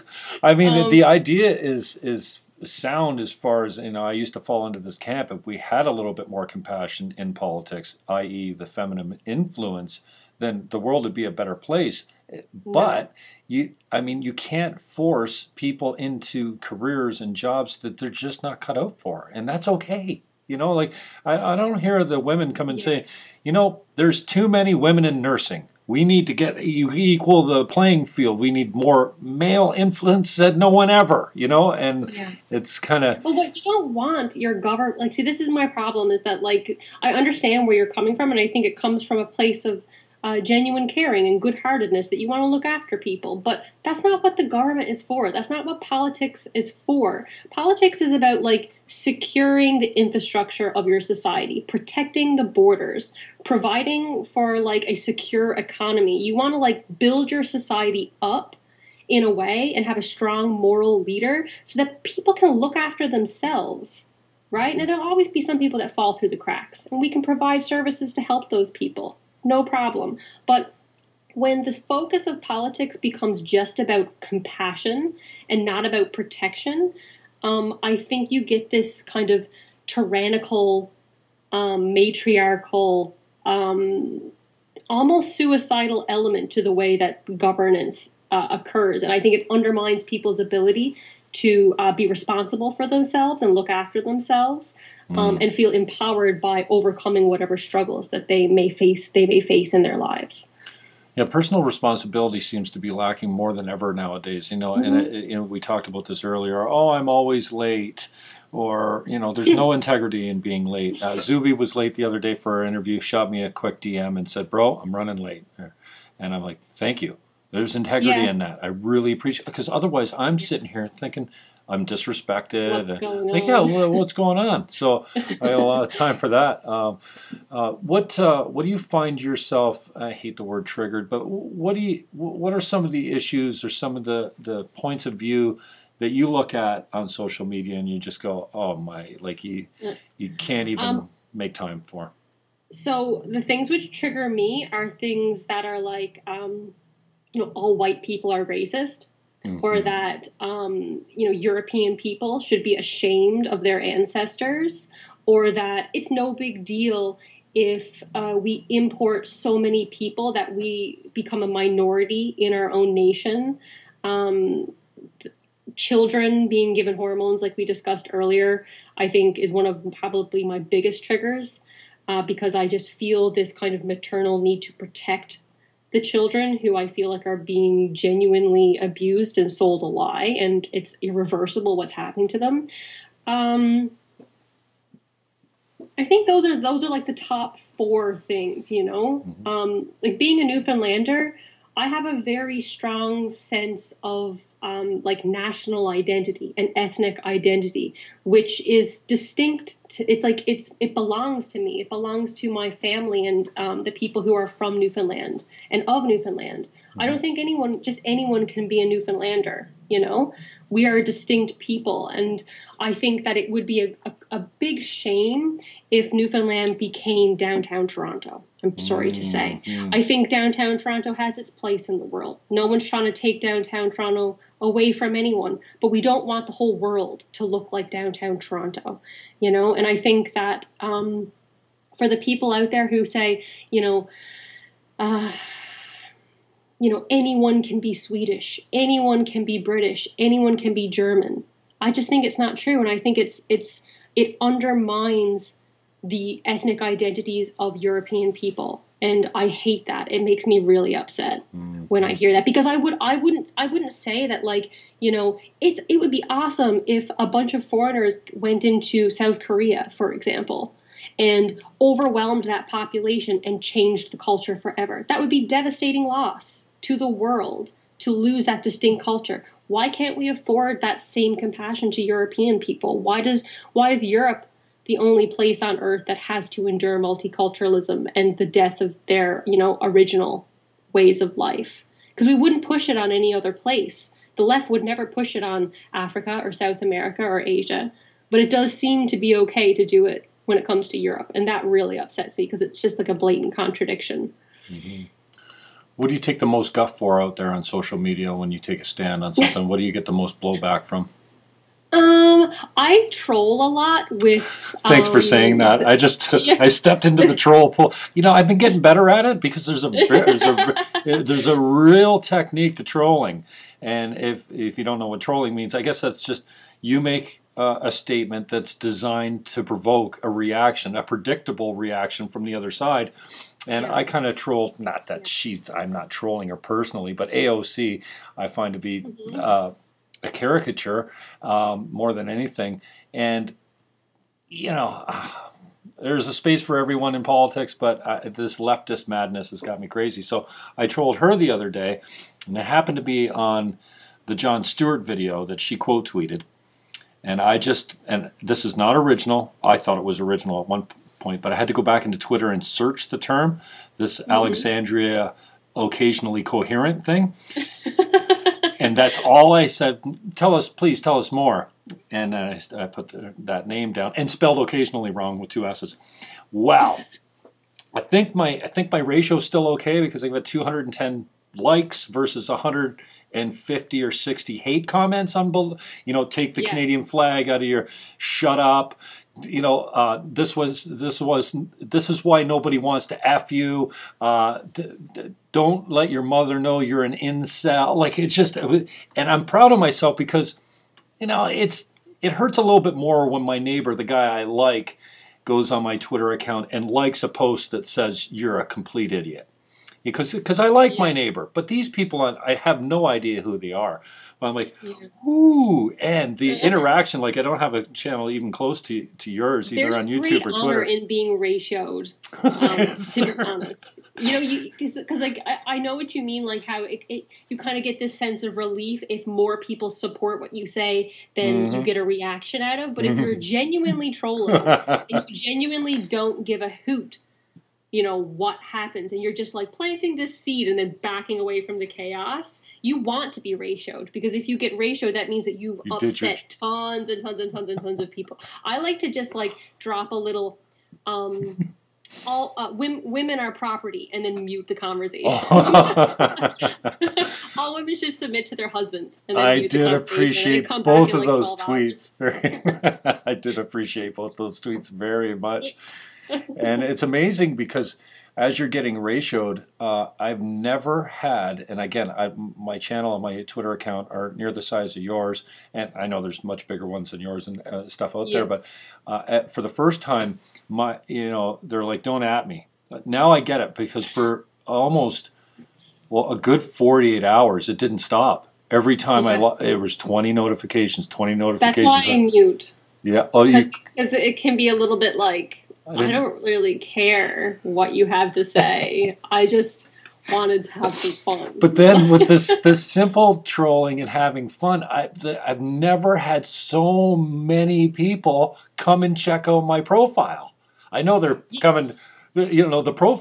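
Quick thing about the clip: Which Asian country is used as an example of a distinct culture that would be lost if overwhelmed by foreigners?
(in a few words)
South Korea.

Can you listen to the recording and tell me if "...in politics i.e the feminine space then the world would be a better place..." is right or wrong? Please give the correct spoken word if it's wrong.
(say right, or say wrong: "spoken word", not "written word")
wrong: "influence", not "space".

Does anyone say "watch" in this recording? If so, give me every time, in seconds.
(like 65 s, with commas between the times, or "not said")
not said.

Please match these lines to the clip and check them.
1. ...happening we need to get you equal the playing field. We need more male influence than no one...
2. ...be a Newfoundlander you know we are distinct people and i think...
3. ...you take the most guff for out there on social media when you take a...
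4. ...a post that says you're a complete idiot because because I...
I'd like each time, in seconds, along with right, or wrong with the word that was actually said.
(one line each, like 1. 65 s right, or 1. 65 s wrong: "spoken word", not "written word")
1. 25 s wrong: "nursing", not "happening"
2. 208 s right
3. 296 s right
4. 397 s right.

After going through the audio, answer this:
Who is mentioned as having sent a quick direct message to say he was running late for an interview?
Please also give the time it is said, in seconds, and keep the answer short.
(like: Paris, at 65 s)
Zuby, at 111 s.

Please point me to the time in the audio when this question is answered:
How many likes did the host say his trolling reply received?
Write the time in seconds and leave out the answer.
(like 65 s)
370 s.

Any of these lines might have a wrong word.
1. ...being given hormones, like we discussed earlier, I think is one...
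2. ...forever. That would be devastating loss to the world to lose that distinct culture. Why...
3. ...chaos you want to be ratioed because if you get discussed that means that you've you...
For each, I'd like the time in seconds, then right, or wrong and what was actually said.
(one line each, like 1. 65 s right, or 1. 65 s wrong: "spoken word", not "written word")
1. 166 s right
2. 264 s right
3. 431 s wrong: "ratioed", not "discussed".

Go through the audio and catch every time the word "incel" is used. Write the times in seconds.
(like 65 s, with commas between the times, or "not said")
387 s.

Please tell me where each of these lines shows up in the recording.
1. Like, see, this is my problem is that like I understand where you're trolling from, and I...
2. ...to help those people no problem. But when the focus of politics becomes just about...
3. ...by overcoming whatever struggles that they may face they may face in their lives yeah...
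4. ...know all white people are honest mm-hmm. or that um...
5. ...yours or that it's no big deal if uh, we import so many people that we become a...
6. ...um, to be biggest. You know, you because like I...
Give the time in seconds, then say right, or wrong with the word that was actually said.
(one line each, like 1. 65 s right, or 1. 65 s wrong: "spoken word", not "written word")
1. 35 s wrong: "coming", not "trolling"
2. 68 s right
3. 96 s right
4. 147 s wrong: "racist", not "honest"
5. 153 s wrong: "ancestors", not "yours"
6. 412 s wrong: "honest", not "biggest".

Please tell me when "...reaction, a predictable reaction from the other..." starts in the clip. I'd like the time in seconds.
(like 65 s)
320 s.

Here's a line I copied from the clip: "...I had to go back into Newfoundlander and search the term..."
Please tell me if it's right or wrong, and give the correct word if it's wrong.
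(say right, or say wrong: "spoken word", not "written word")
wrong: "Twitter", not "Newfoundlander".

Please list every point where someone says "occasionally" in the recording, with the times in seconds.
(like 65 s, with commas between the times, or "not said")
355 s, 364 s.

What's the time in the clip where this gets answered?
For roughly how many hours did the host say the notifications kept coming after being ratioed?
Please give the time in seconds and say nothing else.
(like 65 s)
476 s.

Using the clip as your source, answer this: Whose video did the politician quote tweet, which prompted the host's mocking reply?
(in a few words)
Jon Stewart.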